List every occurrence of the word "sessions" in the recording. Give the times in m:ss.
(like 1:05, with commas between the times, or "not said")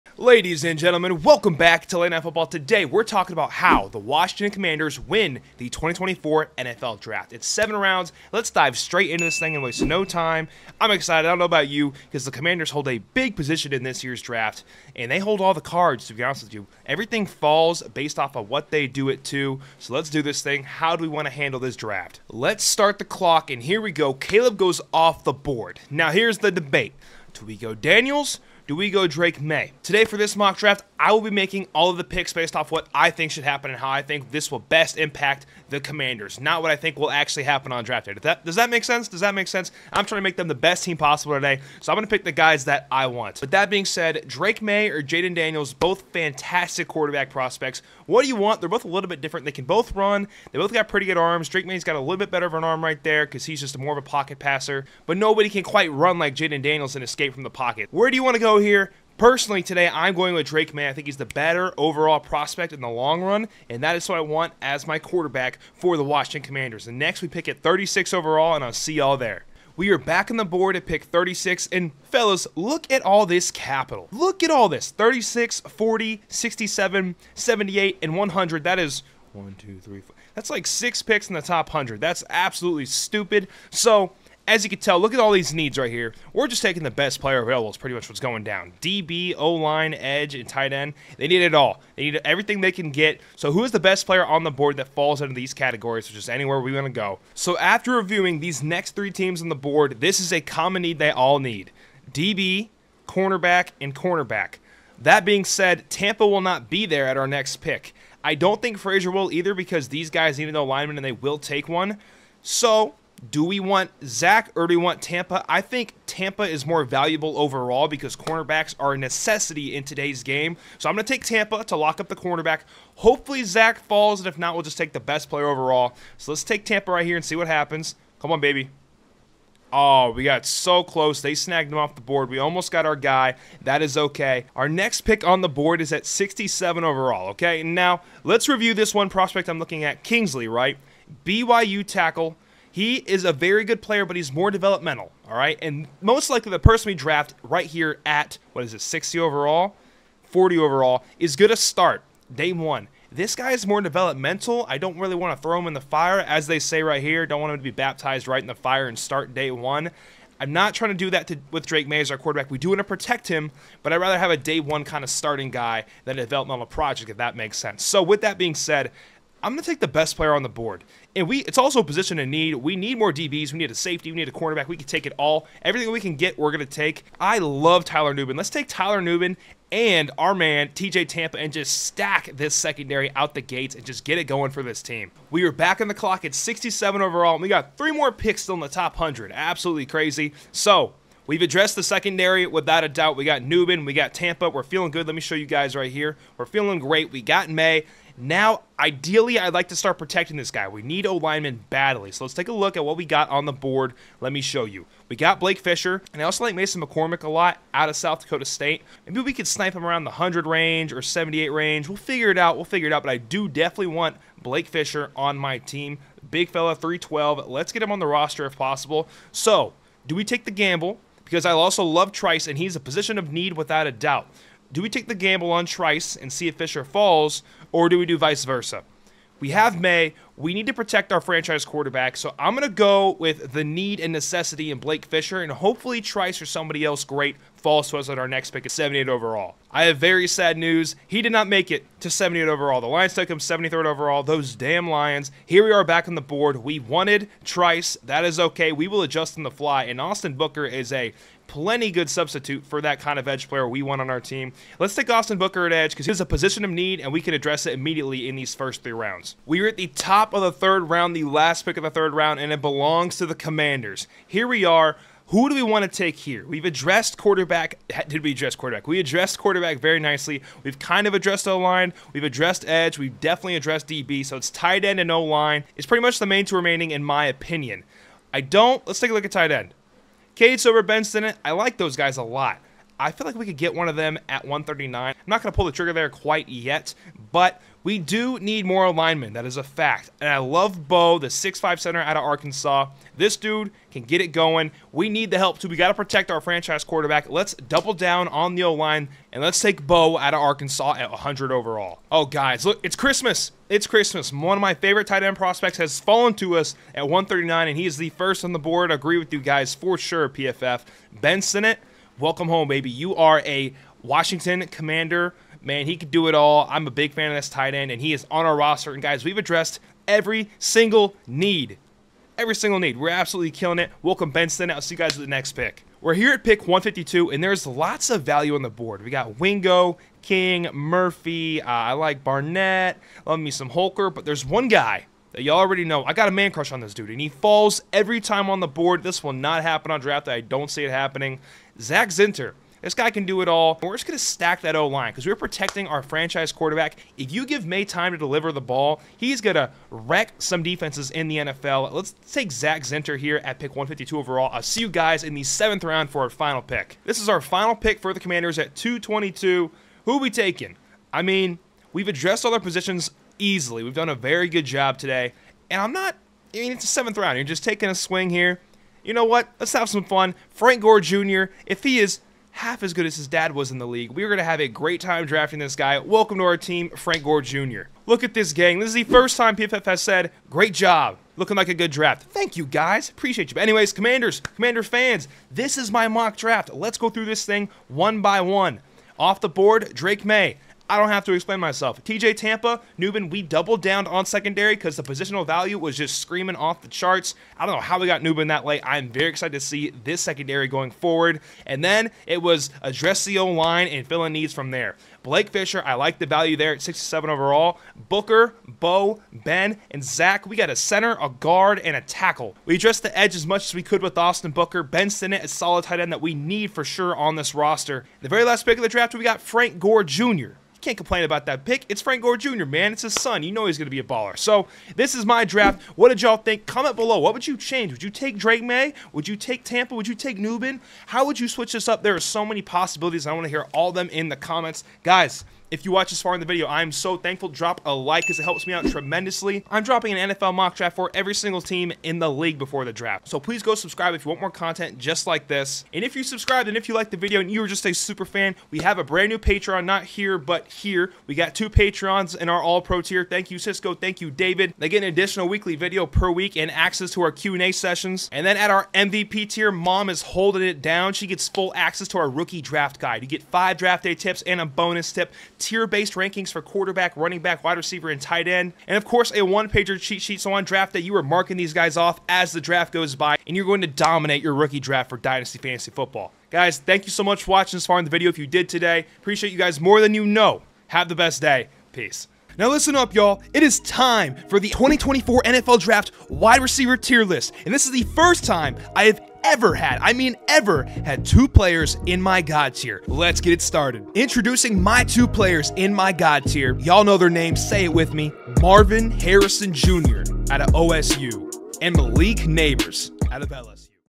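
7:37.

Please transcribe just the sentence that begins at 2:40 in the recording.
I'm not trying to do that to, with Drake Maye as our quarterback.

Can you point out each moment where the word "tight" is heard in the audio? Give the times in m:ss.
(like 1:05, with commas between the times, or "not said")
1:30, 4:34, 4:39, 5:05, 5:17, 6:55, 7:48.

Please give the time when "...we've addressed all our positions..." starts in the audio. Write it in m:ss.
6:01.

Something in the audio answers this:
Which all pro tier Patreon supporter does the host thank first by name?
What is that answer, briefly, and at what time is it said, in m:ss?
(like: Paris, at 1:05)
Cisco, at 7:33.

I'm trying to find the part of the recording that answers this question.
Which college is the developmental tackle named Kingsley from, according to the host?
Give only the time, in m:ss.
2:21.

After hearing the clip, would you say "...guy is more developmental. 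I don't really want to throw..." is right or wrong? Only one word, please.
right.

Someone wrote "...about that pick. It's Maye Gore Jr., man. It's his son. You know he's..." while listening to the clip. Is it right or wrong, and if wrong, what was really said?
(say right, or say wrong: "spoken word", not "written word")
wrong: "Frank", not "Maye".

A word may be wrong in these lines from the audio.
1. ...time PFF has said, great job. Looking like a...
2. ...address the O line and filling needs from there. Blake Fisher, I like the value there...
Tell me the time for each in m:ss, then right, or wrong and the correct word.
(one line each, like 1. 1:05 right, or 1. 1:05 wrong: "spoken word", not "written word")
1. 6:19 right
2. 6:42 right.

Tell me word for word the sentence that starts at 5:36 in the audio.
I got a man crush on this dude, and he falls every time on the board.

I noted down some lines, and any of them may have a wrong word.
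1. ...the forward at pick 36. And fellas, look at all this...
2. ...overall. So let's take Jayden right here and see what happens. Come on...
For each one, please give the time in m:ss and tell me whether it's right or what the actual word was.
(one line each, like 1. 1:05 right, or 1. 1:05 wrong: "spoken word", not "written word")
1. 1:10 wrong: "board", not "forward"
2. 2:05 wrong: "Tampa", not "Jayden".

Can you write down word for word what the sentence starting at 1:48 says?
I don't think Frazier will either because these guys need an alignment and they will take one.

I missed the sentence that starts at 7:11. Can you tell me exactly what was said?
How would you switch this up?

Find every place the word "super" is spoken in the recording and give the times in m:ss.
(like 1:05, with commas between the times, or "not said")
7:27.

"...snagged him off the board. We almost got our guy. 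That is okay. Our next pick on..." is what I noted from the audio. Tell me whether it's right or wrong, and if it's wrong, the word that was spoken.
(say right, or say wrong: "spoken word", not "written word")
right.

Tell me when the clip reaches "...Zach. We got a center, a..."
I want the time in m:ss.
6:50.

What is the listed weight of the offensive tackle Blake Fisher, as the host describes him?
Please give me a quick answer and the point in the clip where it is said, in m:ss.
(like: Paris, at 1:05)
312, at 3:36.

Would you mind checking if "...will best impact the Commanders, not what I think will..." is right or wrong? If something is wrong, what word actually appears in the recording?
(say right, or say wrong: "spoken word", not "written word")
right.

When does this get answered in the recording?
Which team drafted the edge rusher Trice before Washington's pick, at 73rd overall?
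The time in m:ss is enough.
4:02.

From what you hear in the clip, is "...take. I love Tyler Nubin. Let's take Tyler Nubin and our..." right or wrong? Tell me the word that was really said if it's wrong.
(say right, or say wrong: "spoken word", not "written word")
right.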